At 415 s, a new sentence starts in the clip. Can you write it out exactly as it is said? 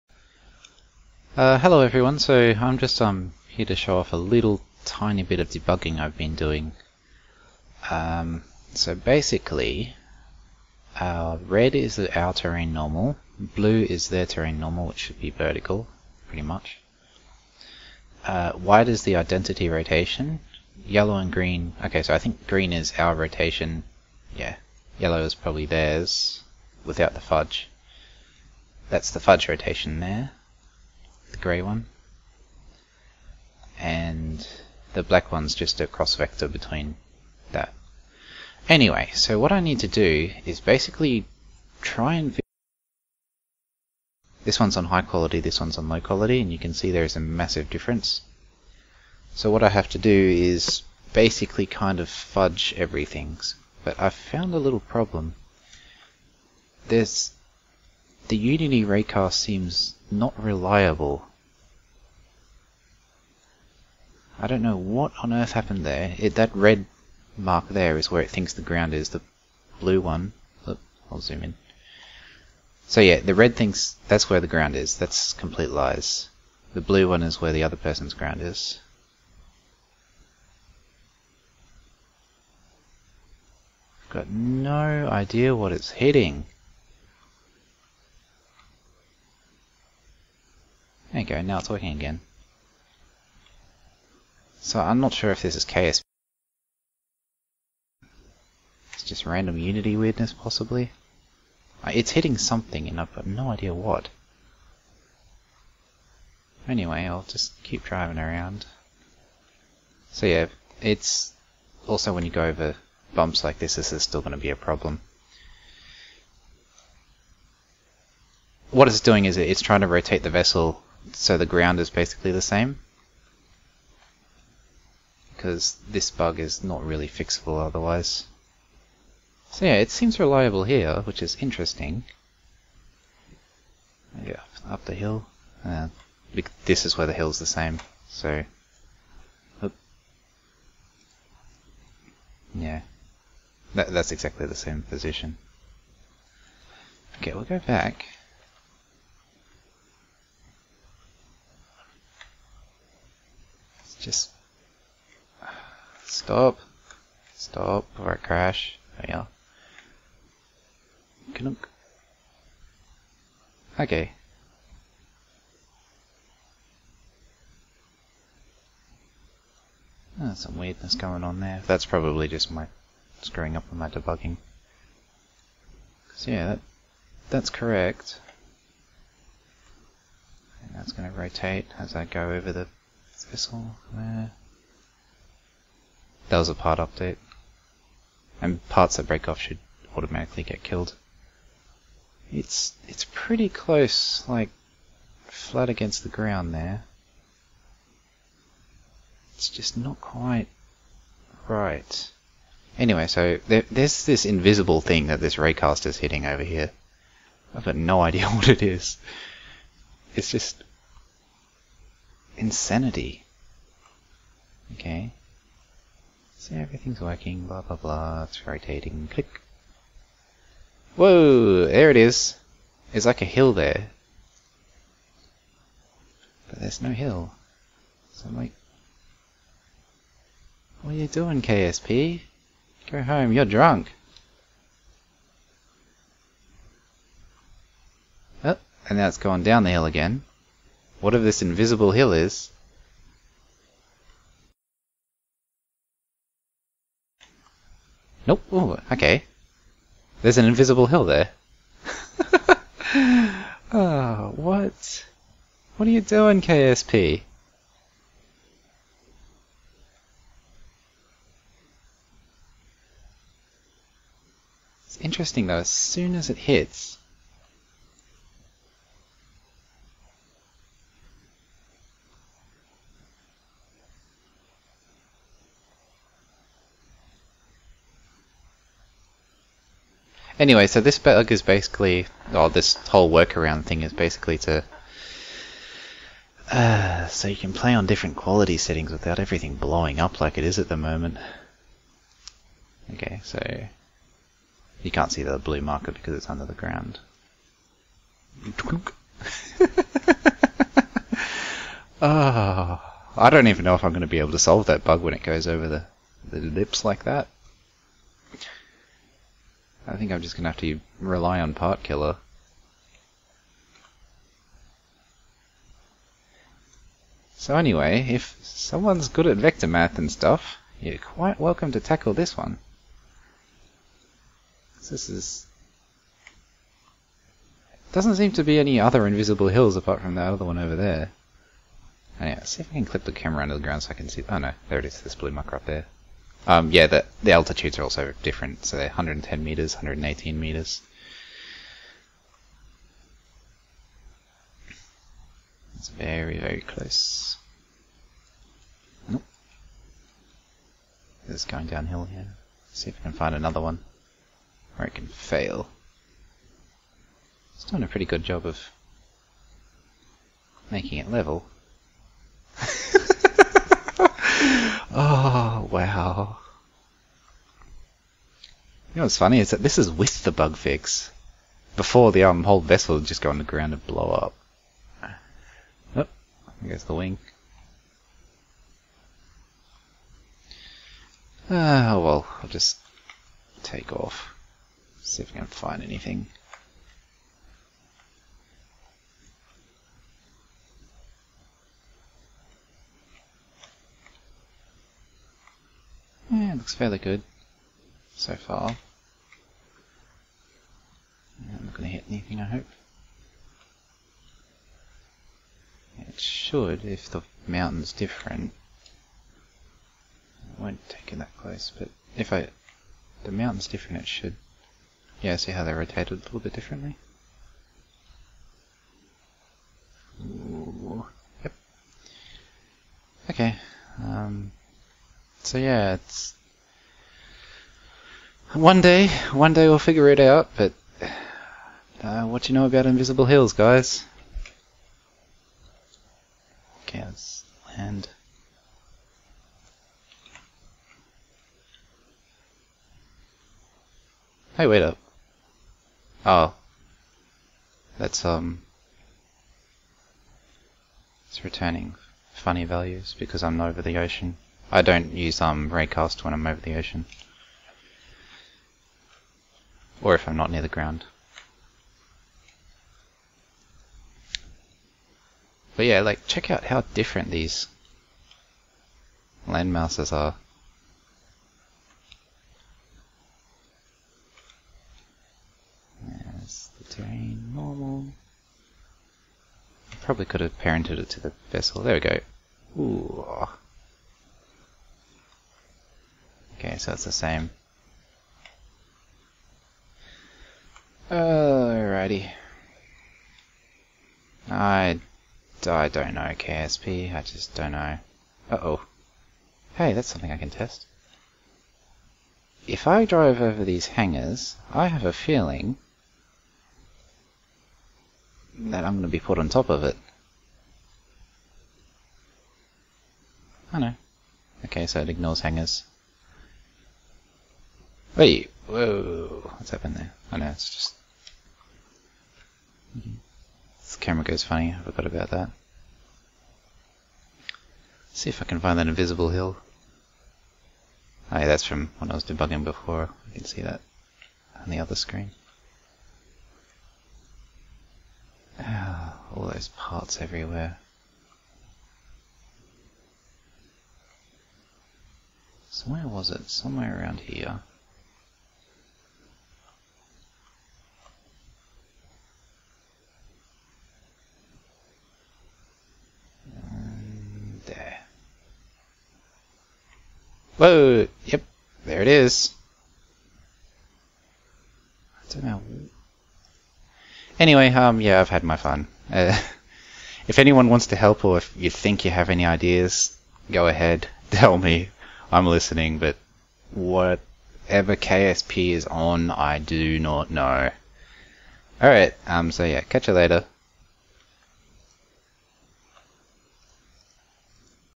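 Yeah, see how they rotated a little bit differently?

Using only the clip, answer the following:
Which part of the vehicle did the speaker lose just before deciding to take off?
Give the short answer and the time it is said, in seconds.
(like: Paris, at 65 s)
The wing, at 376 s.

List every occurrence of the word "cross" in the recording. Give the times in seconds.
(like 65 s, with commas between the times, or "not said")
35 s.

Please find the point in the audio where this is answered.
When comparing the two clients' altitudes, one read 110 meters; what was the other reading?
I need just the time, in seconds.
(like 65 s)
339 s.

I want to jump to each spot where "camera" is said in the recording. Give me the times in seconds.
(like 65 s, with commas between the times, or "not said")
333 s, 523 s.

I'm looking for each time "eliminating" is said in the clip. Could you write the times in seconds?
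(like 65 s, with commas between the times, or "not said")
not said.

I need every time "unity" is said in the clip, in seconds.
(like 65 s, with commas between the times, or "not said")
58 s, 99 s.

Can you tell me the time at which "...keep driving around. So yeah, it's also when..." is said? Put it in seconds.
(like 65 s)
107 s.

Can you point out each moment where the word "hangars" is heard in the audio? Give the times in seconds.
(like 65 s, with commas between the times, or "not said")
503 s, 515 s.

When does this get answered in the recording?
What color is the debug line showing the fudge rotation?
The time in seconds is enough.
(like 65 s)
31 s.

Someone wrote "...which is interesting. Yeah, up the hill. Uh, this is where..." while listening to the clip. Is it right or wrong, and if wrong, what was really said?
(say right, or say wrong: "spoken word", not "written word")
right.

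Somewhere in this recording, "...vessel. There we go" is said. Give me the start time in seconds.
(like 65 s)
481 s.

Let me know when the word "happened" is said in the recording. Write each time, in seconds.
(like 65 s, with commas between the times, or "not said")
65 s, 519 s.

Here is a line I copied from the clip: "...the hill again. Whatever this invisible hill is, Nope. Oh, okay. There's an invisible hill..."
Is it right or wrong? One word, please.
right.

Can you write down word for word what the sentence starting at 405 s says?
It should, if the mountain's different.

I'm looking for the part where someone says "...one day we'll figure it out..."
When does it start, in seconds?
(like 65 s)
429 s.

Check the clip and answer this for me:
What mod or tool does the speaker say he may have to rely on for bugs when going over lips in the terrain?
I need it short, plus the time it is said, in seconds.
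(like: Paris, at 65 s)
Part Killer, at 311 s.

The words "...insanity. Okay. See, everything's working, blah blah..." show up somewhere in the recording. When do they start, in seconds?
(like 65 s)
212 s.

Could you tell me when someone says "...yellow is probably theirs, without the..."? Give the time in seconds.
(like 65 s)
24 s.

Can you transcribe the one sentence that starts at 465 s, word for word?
But yeah, like, check out how different these land masses are.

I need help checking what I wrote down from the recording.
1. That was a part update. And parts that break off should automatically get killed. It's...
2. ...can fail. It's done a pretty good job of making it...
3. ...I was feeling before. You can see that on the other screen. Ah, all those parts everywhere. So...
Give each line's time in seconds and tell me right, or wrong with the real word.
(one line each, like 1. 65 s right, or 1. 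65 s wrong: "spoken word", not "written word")
1. 186 s right
2. 354 s right
3. 532 s wrong: "debugging", not "feeling".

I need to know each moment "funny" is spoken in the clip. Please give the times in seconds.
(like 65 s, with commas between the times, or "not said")
369 s, 452 s, 524 s.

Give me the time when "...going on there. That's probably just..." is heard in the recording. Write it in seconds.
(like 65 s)
170 s.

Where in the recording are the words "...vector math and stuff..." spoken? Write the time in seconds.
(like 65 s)
319 s.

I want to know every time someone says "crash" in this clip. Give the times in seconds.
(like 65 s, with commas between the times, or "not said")
158 s.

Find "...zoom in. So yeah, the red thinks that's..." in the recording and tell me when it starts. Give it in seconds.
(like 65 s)
71 s.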